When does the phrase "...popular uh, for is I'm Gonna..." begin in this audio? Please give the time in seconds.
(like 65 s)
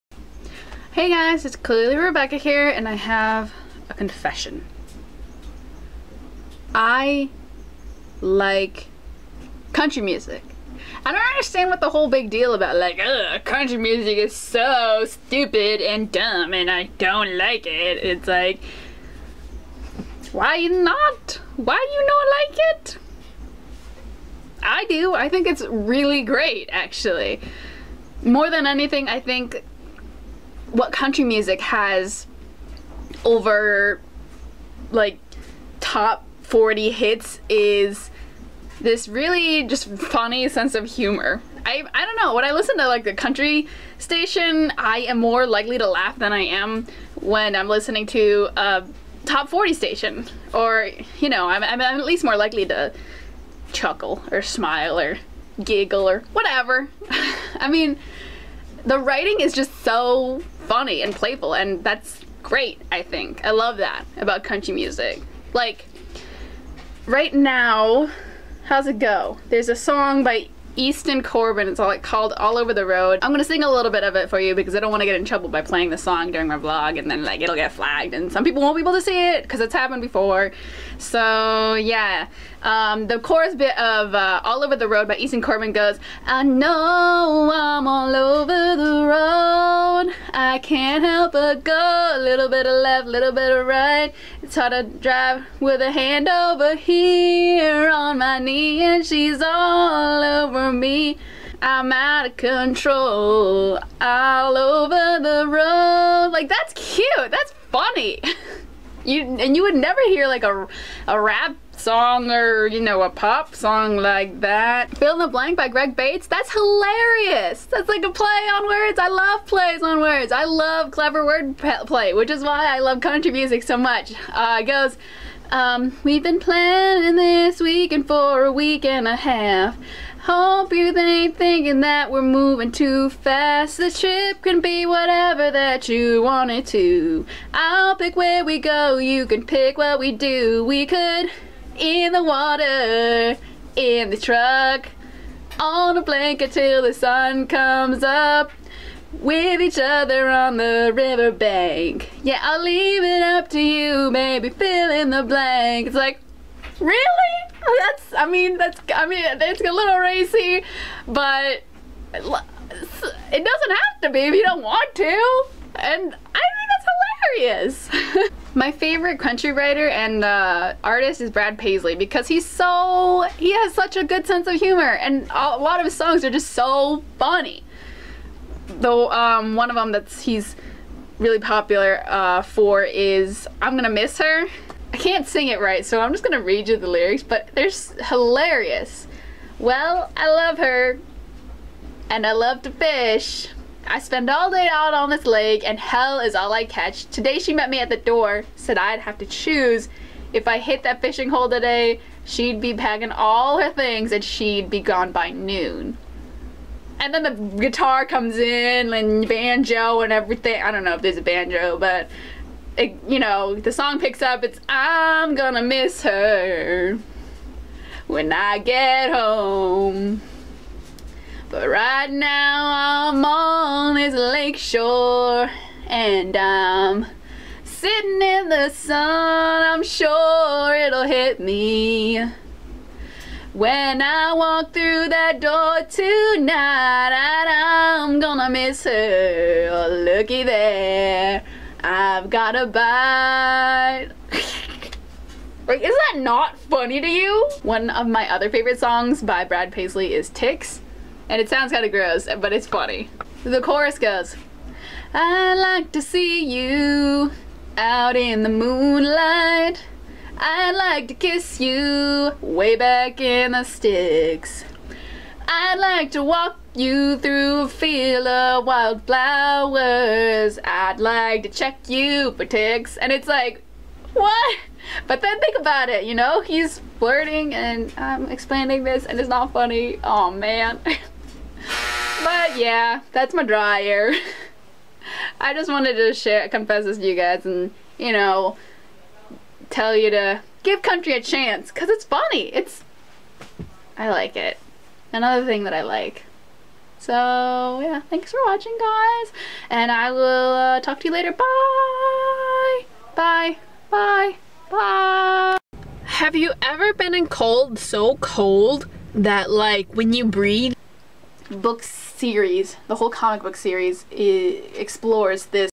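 181 s.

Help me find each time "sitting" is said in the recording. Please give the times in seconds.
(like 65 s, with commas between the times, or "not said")
227 s.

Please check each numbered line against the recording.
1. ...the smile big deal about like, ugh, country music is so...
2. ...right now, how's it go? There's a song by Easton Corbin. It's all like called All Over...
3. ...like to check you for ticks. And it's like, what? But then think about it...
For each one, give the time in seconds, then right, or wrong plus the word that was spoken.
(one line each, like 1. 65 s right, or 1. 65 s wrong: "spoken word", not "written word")
1. 11 s wrong: "whole", not "smile"
2. 67 s right
3. 270 s right.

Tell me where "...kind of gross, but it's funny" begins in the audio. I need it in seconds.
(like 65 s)
251 s.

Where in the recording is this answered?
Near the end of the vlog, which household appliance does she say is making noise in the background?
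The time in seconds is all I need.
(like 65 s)
283 s.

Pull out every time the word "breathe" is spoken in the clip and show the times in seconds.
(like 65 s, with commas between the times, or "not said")
310 s.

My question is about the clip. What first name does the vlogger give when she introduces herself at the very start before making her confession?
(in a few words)
Rebecca.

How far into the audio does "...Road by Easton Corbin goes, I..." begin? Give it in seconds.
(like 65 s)
84 s.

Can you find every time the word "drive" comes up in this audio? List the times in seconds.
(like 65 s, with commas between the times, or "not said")
94 s.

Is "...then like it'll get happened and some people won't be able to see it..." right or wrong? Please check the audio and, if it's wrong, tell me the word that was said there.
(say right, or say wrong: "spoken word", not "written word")
wrong: "flagged", not "happened".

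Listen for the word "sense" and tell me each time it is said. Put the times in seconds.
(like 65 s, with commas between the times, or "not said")
40 s, 174 s.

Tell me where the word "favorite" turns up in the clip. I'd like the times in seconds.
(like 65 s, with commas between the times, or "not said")
168 s, 248 s.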